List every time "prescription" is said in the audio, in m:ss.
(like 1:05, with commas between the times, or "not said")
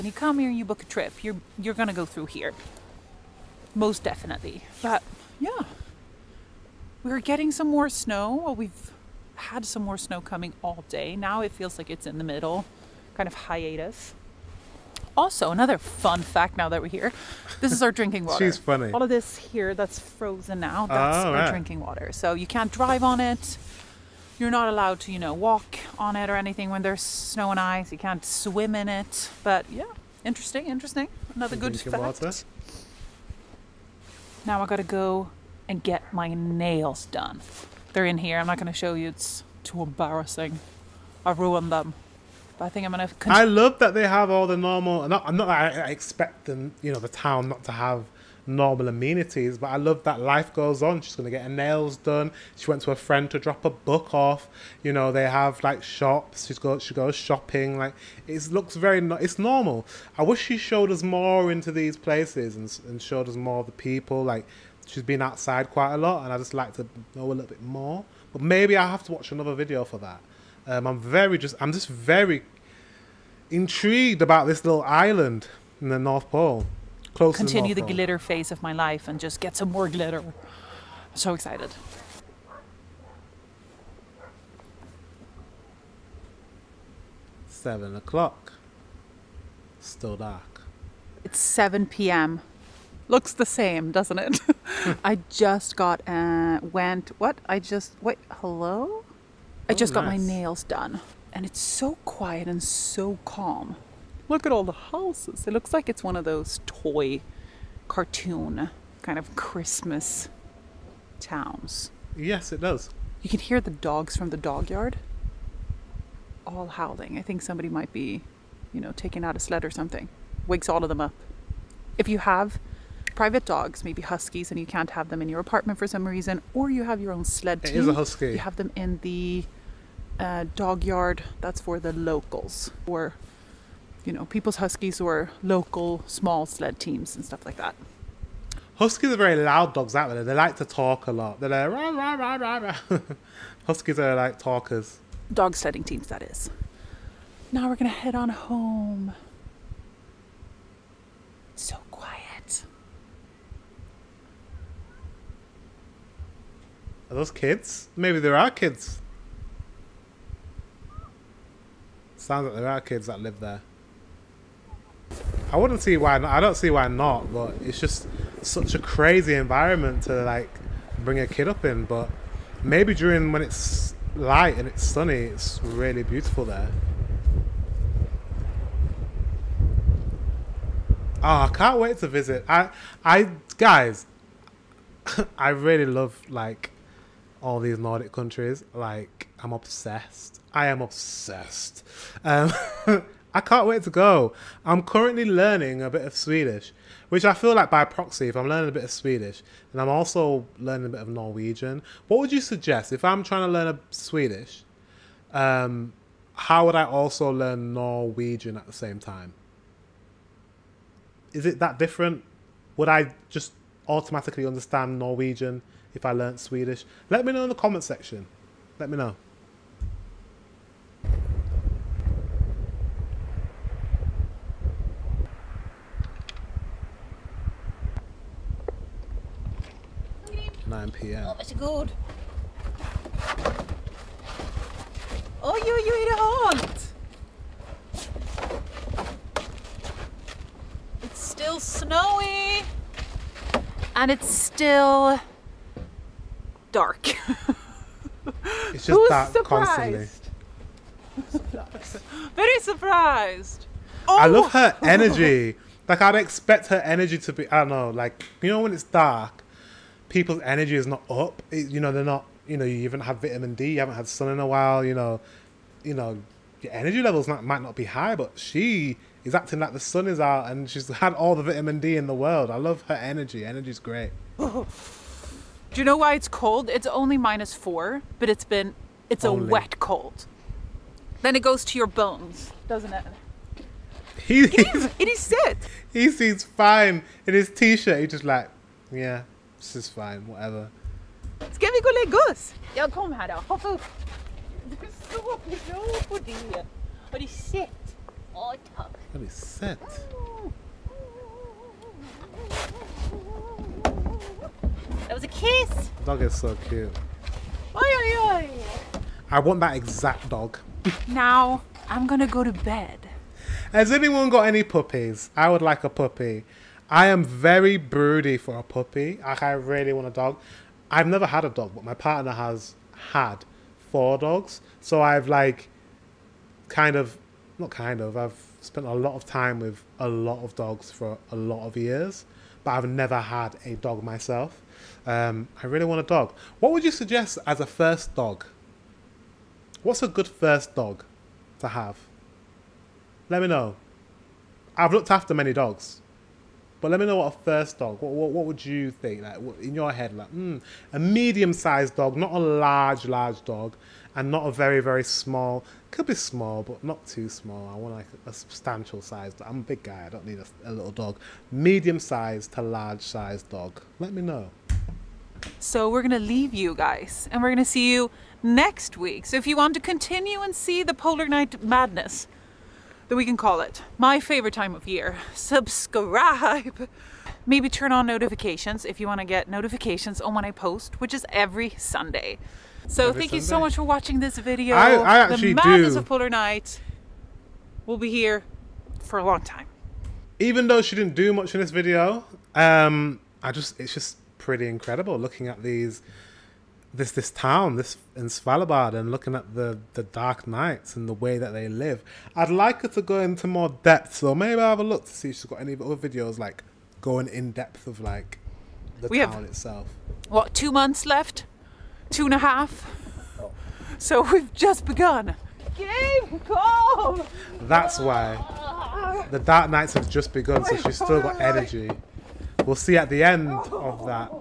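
not said.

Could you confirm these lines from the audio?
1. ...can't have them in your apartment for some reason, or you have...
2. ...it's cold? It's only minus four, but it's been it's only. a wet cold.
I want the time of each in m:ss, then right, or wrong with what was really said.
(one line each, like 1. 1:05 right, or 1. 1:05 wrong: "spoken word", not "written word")
1. 2:04 right
2. 4:36 right.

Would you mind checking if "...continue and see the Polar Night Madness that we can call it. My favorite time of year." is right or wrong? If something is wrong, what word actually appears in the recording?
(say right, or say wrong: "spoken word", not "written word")
right.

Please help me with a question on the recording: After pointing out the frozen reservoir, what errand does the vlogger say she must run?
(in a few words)
get her nails done.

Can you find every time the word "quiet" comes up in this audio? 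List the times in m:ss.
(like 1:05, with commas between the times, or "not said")
1:42, 2:31.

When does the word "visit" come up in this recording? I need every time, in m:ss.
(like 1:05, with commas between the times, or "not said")
3:02.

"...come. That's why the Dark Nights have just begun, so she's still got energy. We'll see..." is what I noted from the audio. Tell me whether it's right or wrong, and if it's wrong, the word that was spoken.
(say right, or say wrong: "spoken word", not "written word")
right.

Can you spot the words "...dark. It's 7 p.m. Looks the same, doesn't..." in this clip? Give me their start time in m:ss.
1:30.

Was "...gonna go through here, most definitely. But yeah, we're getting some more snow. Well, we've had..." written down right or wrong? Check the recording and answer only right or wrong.
right.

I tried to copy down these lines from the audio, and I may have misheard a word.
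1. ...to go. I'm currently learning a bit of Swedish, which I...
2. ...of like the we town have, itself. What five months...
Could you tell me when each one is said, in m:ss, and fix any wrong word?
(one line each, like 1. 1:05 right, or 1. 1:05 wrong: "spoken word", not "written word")
1. 3:13 right
2. 6:47 wrong: "two", not "five".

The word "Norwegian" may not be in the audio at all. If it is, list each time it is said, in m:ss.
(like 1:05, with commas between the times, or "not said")
3:21, 3:27, 3:34.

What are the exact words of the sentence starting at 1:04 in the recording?
Like she's been outside quite a lot and I just like to know a little bit more.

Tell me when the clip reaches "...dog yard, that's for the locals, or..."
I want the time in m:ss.
2:10.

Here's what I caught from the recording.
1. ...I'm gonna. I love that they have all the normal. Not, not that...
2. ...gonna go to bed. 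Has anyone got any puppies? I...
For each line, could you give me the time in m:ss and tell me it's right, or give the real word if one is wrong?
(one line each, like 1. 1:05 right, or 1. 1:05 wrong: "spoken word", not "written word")
1. 0:42 right
2. 5:12 right.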